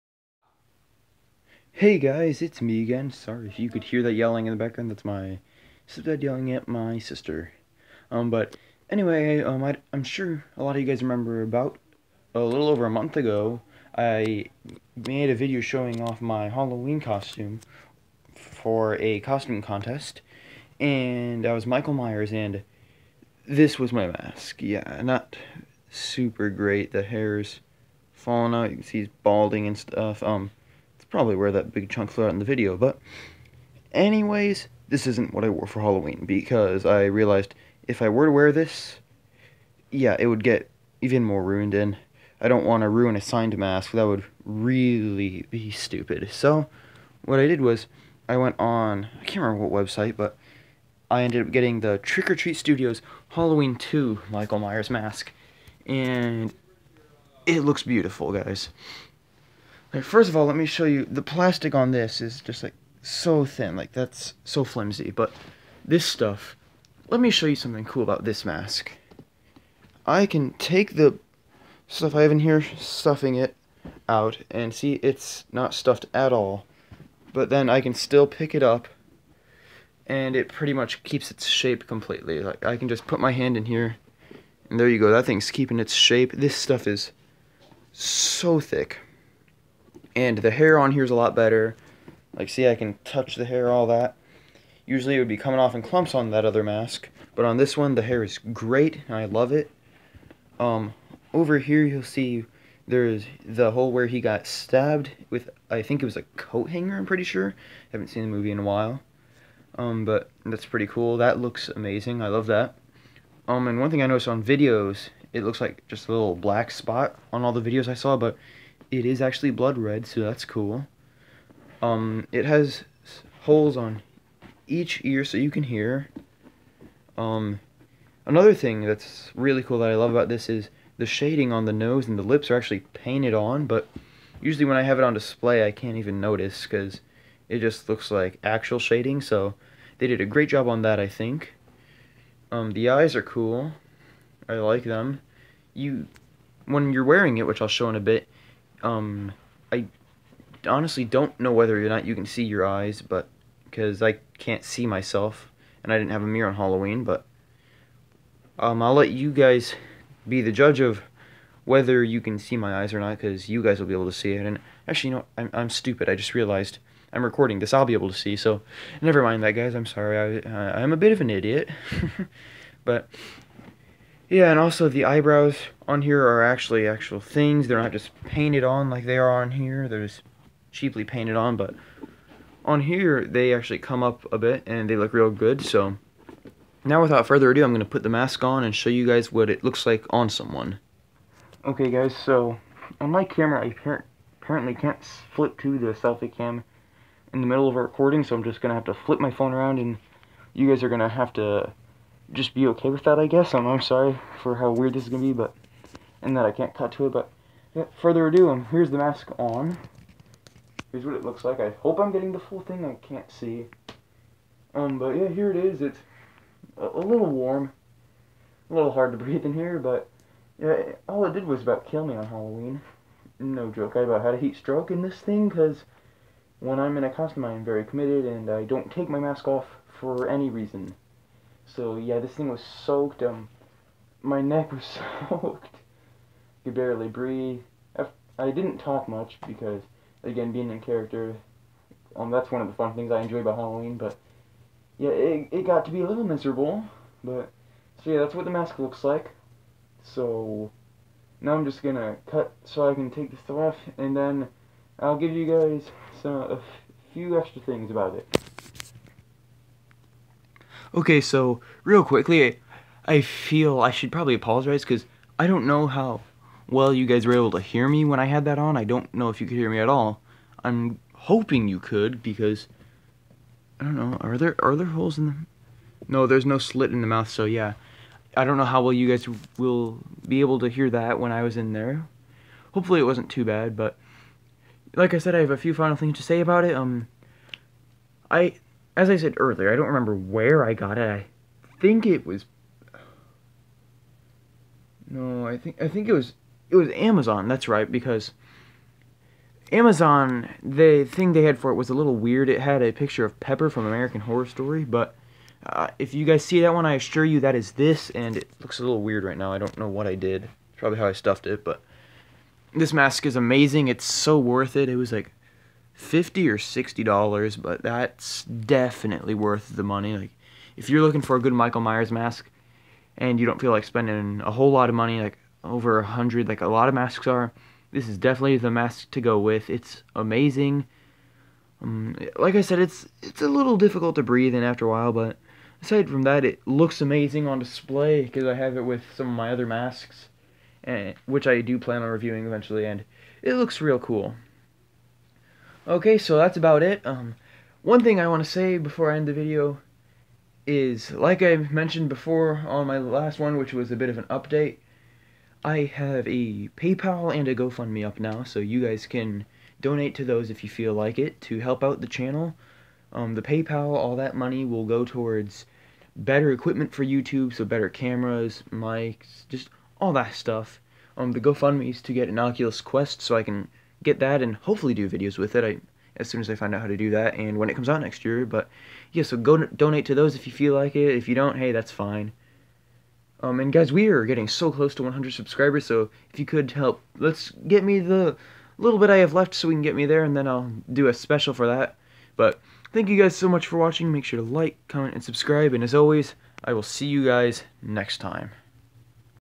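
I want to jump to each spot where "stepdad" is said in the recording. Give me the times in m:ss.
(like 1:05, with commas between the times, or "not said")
0:05.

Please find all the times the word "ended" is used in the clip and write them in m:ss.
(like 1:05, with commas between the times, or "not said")
0:51.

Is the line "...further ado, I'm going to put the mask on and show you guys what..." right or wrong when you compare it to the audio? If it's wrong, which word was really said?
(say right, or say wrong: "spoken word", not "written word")
right.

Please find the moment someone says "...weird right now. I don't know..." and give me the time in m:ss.
5:09.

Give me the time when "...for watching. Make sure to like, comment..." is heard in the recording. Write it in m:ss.
6:33.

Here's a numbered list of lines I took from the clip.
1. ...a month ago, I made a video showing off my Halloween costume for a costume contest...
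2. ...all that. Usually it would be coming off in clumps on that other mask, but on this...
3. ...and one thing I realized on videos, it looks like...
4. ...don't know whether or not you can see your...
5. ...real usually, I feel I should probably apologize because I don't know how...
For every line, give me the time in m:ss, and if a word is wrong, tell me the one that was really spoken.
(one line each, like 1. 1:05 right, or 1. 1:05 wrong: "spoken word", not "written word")
1. 0:12 right
2. 1:33 right
3. 1:53 wrong: "noticed", not "realized"
4. 2:31 right
5. 4:21 wrong: "quickly", not "usually".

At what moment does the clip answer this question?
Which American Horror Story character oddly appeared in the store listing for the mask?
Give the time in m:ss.
5:03.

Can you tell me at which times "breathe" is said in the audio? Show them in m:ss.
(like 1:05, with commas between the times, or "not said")
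3:39, 3:57, 5:34.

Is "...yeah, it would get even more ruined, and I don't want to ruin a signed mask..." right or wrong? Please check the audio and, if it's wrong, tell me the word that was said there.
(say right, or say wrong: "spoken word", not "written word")
right.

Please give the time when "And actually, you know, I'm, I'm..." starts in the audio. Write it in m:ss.
2:44.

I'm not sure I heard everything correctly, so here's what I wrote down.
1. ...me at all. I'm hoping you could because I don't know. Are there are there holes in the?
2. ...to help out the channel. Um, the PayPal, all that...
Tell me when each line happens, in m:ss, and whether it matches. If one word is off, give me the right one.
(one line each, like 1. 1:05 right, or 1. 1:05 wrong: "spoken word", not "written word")
1. 4:29 right
2. 6:01 right.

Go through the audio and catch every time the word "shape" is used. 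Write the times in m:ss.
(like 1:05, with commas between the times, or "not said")
1:21, 1:25.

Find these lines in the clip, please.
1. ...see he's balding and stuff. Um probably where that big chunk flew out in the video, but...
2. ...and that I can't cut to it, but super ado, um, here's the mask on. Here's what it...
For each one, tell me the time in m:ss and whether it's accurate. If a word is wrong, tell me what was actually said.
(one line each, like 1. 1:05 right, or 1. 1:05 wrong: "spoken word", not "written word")
1. 0:28 right
2. 3:26 wrong: "further", not "super".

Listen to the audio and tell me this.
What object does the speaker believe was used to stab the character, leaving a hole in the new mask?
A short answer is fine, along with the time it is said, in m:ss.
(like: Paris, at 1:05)
coat hanger, at 1:46.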